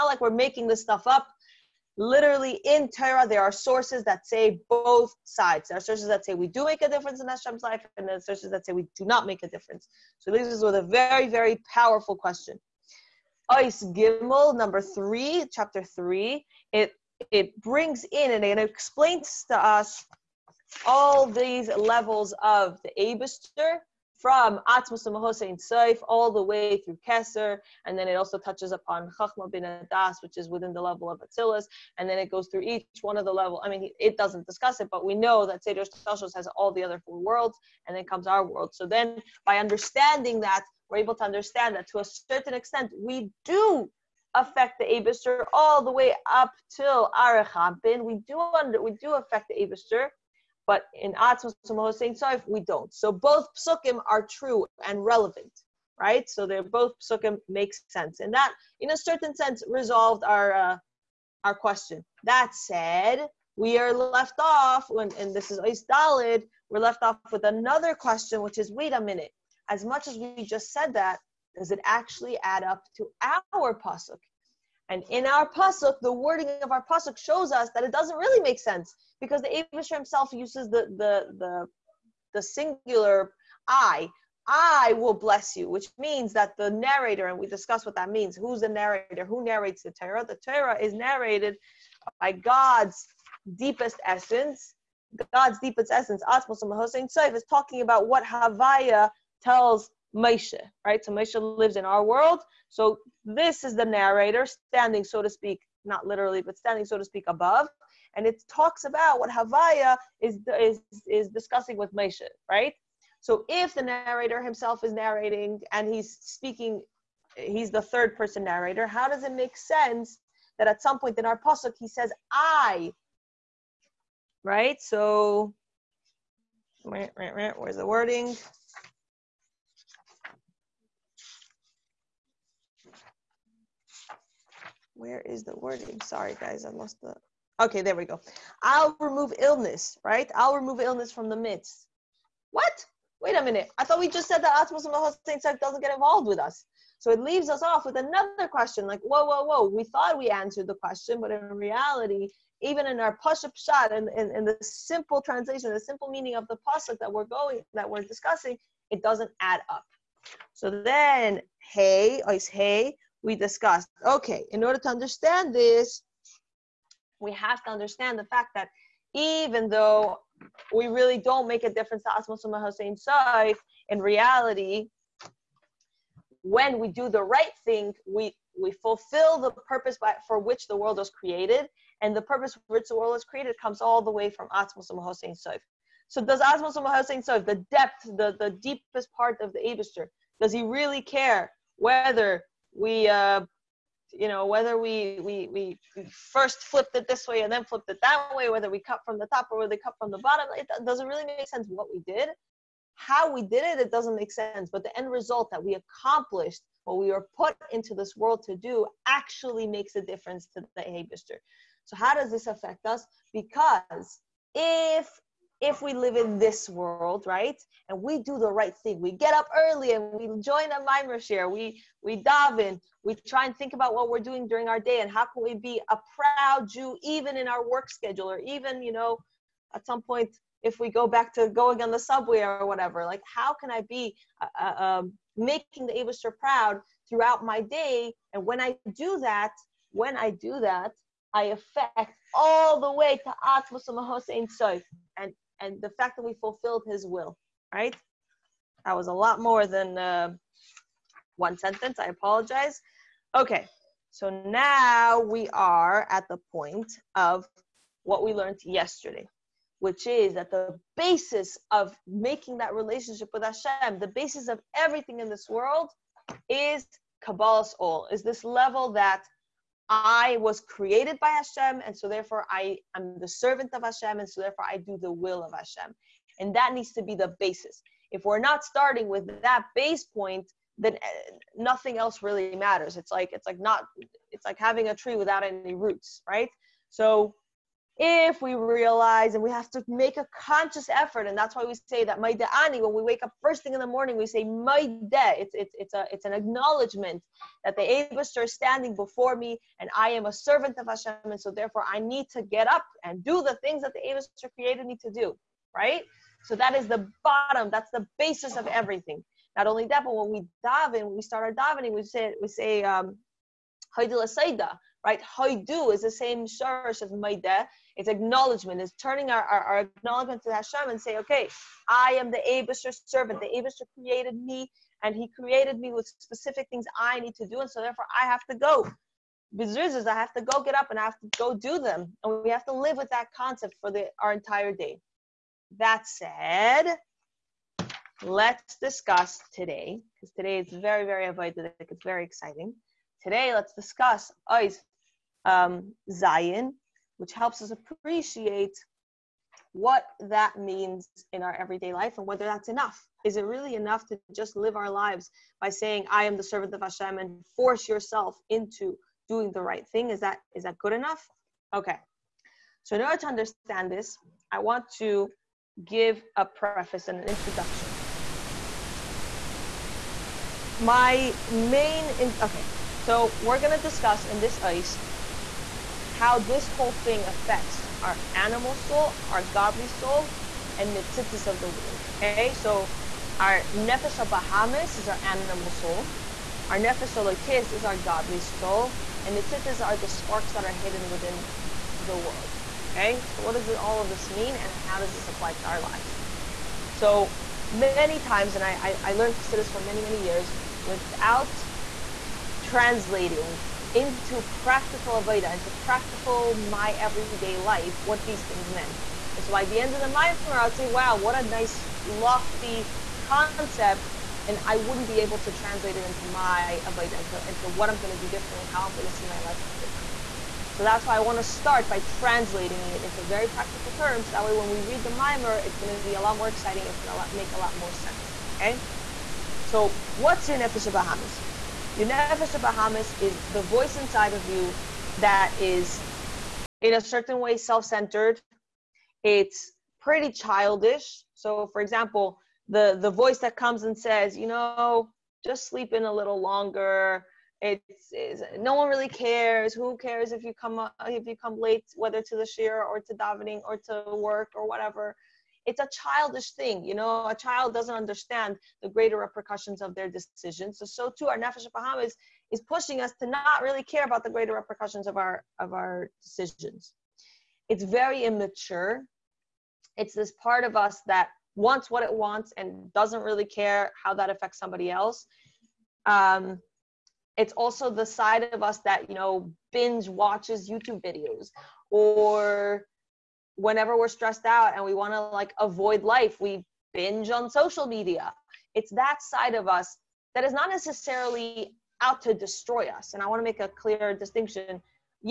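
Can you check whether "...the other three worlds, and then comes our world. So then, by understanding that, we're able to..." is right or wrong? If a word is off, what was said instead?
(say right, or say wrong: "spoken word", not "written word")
wrong: "four", not "three".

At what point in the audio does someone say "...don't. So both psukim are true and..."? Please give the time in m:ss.
0:52.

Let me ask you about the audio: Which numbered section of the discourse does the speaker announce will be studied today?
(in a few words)
Zayin.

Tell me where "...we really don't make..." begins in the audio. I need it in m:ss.
2:50.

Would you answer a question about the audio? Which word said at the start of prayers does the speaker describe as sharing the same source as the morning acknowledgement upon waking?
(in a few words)
Haidu.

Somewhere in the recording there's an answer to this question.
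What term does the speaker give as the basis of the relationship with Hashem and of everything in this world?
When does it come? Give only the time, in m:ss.
4:27.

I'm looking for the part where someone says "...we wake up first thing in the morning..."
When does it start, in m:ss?
4:52.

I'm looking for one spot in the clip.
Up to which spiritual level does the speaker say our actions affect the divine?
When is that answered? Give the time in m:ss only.
0:47.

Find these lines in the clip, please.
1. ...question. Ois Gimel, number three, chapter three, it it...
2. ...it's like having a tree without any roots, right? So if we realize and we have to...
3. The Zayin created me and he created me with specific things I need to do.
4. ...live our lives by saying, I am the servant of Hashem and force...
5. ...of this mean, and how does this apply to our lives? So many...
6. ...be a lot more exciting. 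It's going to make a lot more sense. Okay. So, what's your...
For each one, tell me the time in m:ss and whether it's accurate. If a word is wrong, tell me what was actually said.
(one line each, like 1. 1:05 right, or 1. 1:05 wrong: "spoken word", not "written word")
1. 0:12 right
2. 4:44 right
3. 5:23 wrong: "Abishur", not "Zayin"
4. 5:54 right
5. 6:34 right
6. 7:06 right.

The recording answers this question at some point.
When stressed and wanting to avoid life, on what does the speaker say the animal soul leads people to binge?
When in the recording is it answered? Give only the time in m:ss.
8:07.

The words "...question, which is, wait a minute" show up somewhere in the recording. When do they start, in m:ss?
1:07.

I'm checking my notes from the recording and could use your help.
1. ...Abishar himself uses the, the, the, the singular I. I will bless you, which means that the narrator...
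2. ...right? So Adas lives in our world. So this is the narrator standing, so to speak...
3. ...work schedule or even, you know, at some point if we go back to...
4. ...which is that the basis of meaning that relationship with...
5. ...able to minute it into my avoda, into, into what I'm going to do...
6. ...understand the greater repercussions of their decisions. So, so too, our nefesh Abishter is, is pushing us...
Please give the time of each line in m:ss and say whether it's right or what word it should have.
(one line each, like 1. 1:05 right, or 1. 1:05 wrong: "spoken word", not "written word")
1. 1:19 right
2. 1:40 wrong: "Moshe", not "Adas"
3. 3:47 right
4. 4:19 wrong: "making", not "meaning"
5. 6:55 wrong: "translate", not "minute"
6. 7:37 wrong: "Baham", not "Abishter".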